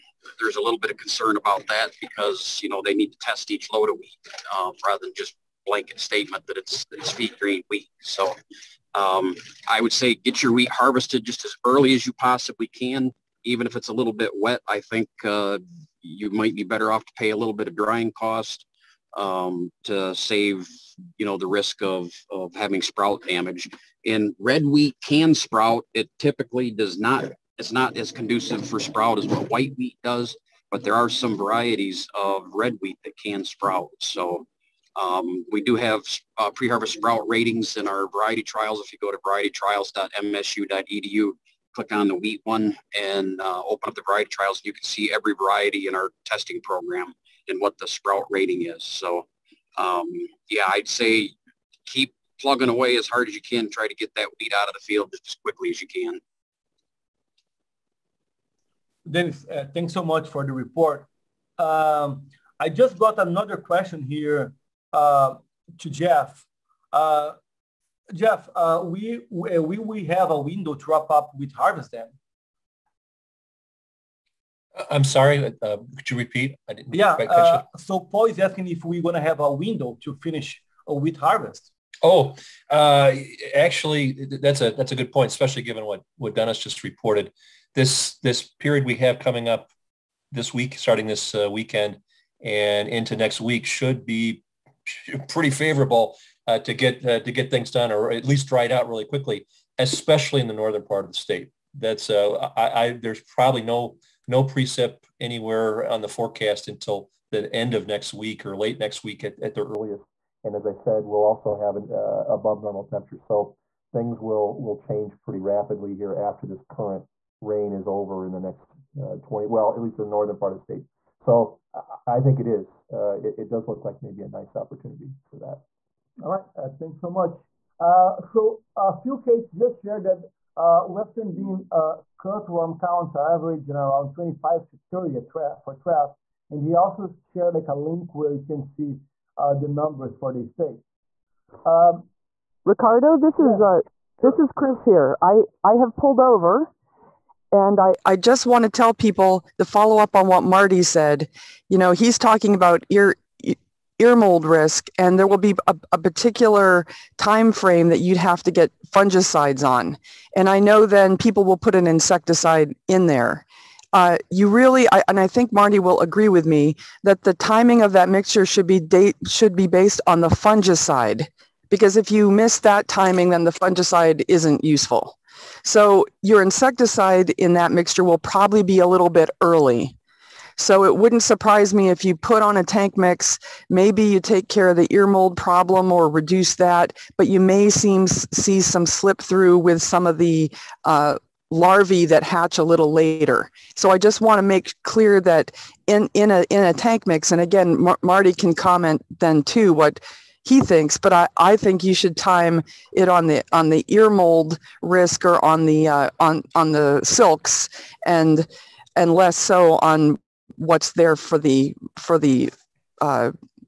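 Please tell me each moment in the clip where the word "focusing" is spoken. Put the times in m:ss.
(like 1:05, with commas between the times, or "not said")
not said.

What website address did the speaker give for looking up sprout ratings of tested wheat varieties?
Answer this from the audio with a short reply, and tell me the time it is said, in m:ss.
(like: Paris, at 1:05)
varietytrials.msu.edu, at 0:39.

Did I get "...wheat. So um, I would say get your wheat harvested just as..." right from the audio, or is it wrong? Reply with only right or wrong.
right.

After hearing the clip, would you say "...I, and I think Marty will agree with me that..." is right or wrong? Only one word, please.
right.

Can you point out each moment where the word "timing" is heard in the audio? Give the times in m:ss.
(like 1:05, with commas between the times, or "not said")
2:47, 2:52.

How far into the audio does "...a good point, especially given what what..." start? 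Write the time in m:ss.
1:24.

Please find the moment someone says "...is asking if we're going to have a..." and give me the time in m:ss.
1:18.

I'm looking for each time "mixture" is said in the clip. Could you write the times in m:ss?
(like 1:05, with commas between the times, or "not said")
2:48, 2:57.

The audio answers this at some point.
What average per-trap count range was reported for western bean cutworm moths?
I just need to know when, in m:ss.
2:14.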